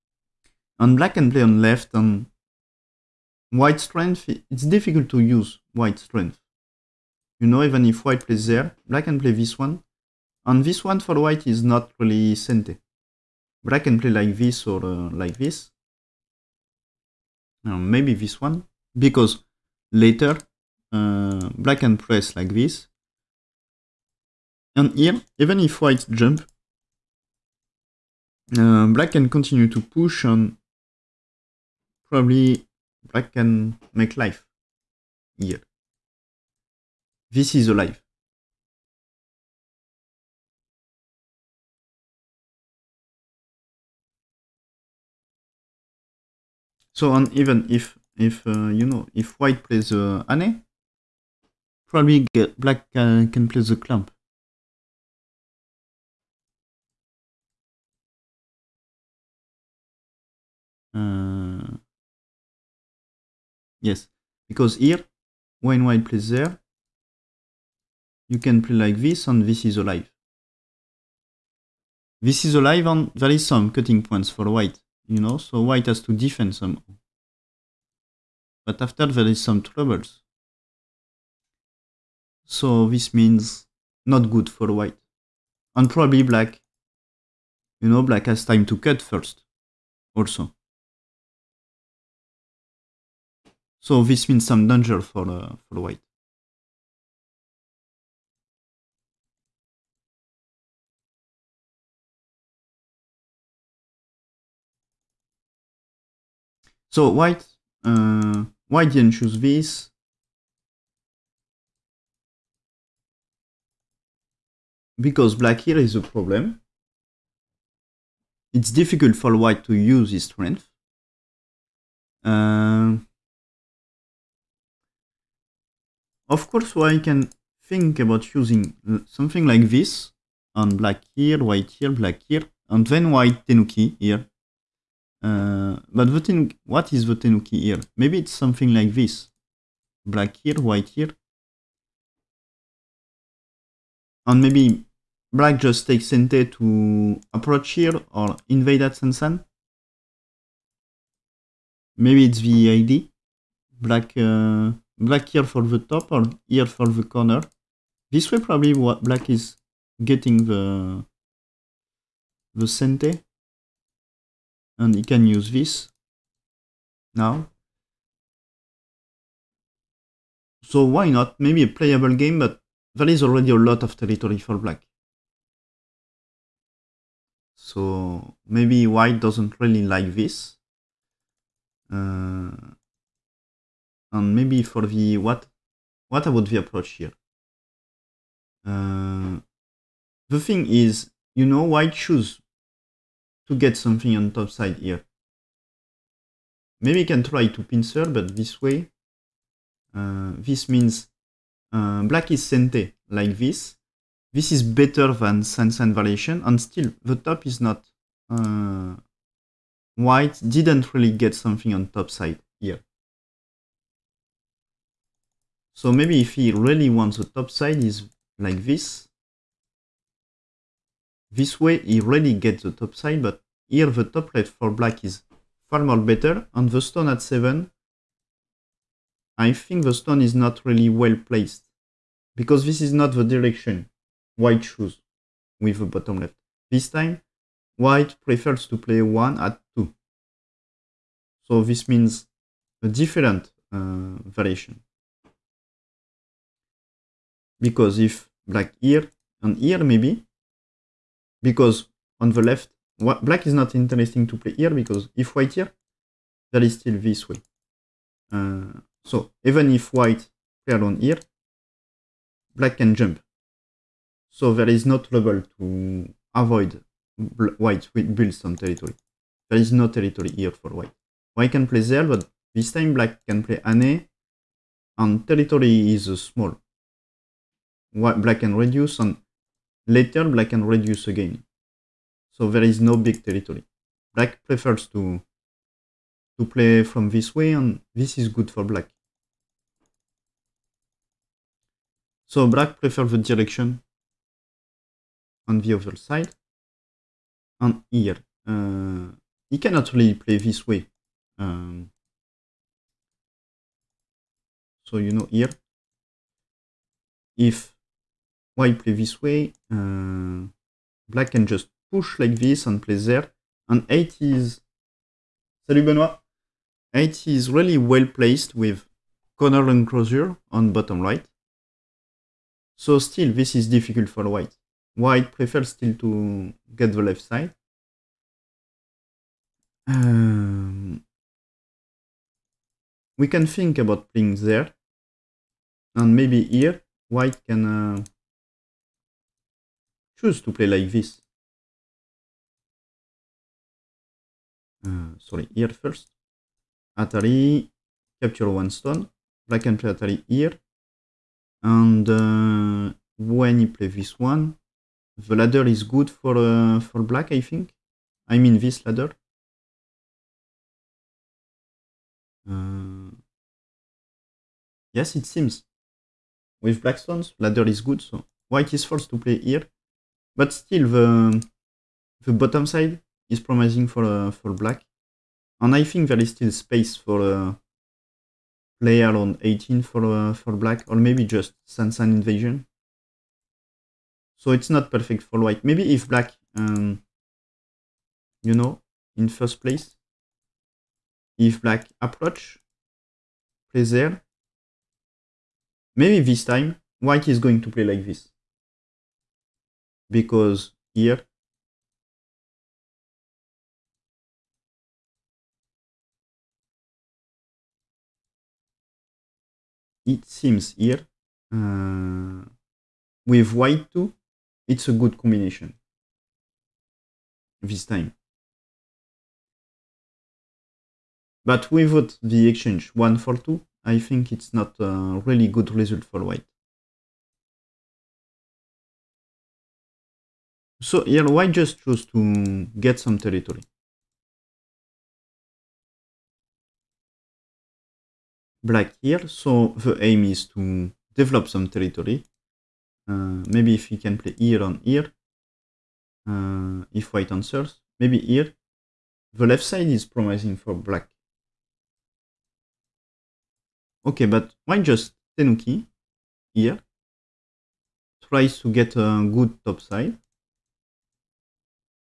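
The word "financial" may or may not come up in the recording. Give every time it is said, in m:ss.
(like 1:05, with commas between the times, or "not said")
not said.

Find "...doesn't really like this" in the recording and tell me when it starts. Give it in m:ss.
2:59.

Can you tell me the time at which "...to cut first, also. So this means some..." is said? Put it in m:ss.
1:28.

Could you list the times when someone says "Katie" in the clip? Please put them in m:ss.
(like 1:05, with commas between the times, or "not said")
not said.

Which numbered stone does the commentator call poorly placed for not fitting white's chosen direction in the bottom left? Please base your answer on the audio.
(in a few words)
7.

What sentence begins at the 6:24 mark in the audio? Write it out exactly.
So it's not perfect for white.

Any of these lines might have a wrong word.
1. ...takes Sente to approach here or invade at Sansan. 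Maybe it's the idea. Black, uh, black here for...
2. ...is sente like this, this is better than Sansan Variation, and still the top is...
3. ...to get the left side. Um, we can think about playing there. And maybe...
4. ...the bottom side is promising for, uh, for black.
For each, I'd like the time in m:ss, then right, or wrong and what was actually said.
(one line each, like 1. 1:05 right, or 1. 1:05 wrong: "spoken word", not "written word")
1. 2:25 right
2. 3:22 right
3. 5:25 right
4. 6:12 right.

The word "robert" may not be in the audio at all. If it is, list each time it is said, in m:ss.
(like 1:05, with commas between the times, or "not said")
not said.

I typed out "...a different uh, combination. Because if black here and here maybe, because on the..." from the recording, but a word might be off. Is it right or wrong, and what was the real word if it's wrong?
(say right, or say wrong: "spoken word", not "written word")
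wrong: "variation", not "combination".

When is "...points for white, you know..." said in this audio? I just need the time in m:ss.
1:14.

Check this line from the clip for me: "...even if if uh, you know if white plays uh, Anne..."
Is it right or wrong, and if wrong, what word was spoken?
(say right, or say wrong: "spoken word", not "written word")
right.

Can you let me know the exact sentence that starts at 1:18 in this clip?
But after there is some troubles.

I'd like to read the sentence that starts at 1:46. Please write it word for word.
So white, uh, didn't choose this?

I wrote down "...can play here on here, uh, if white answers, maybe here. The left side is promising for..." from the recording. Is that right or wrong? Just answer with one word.
right.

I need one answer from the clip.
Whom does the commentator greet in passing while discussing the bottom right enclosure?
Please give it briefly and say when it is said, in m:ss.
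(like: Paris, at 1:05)
Benoit, at 5:15.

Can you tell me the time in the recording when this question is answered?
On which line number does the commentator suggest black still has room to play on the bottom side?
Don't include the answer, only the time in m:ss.
6:19.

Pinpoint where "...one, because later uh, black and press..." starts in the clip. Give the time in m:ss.
0:18.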